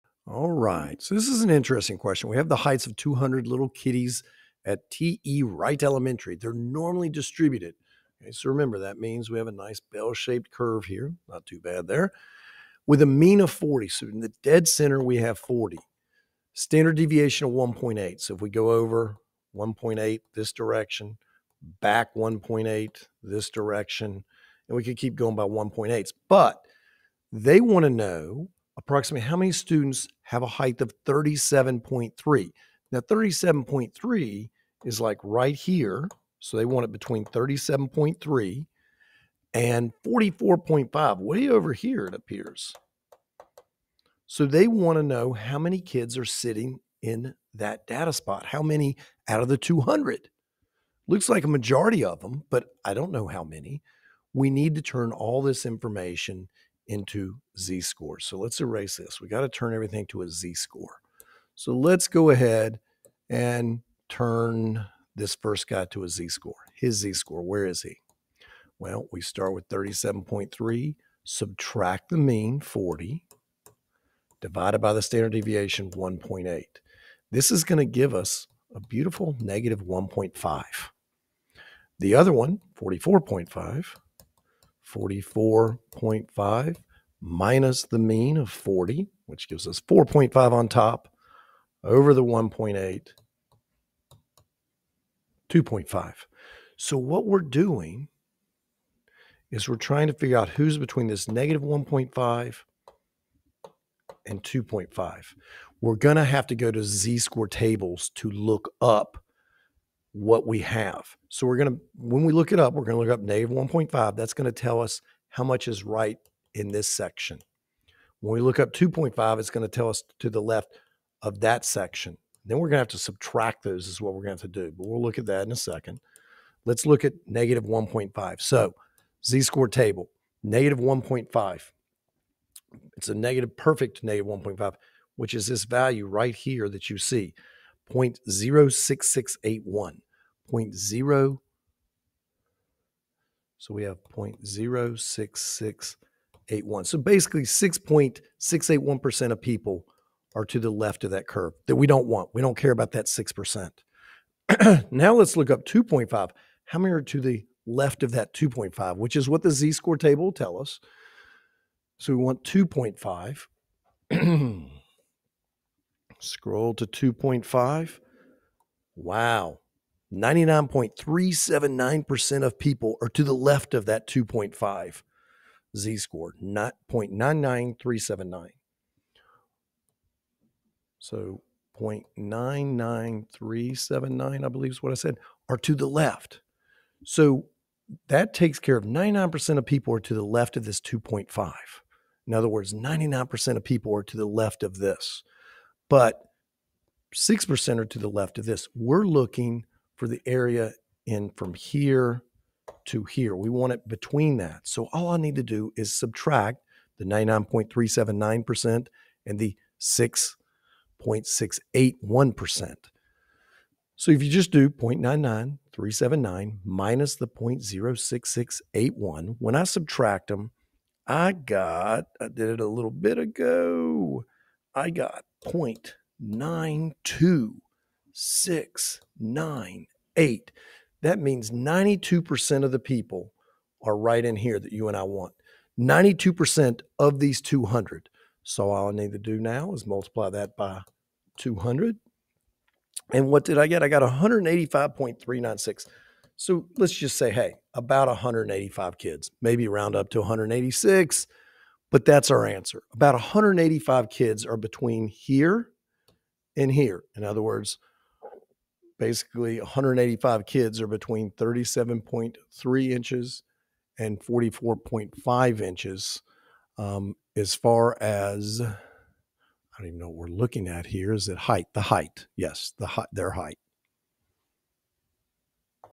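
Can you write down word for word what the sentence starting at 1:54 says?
That's going to tell us how much is right in this section.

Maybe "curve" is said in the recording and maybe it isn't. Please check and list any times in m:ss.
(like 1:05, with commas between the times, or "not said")
0:10, 2:31.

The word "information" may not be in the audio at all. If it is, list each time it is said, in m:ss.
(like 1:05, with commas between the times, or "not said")
0:55.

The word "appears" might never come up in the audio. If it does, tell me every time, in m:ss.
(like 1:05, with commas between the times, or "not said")
0:42.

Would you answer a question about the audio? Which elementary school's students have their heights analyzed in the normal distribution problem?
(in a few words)
TE Wright Elementary.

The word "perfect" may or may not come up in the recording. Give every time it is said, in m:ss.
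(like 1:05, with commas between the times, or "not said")
2:13.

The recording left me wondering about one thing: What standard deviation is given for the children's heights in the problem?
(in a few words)
1.8.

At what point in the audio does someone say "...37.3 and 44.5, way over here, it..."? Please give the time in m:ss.
0:37.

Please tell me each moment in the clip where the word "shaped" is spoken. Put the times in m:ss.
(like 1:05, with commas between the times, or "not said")
0:09.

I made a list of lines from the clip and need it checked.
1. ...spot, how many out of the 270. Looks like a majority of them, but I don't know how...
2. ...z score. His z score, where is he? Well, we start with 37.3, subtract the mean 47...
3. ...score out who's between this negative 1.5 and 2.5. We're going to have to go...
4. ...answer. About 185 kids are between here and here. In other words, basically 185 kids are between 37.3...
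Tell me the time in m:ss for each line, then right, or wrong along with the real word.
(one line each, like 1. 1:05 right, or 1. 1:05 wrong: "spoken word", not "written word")
1. 0:48 wrong: "200", not "270"
2. 1:06 wrong: "40", not "47"
3. 1:40 wrong: "figure", not "score"
4. 4:12 right.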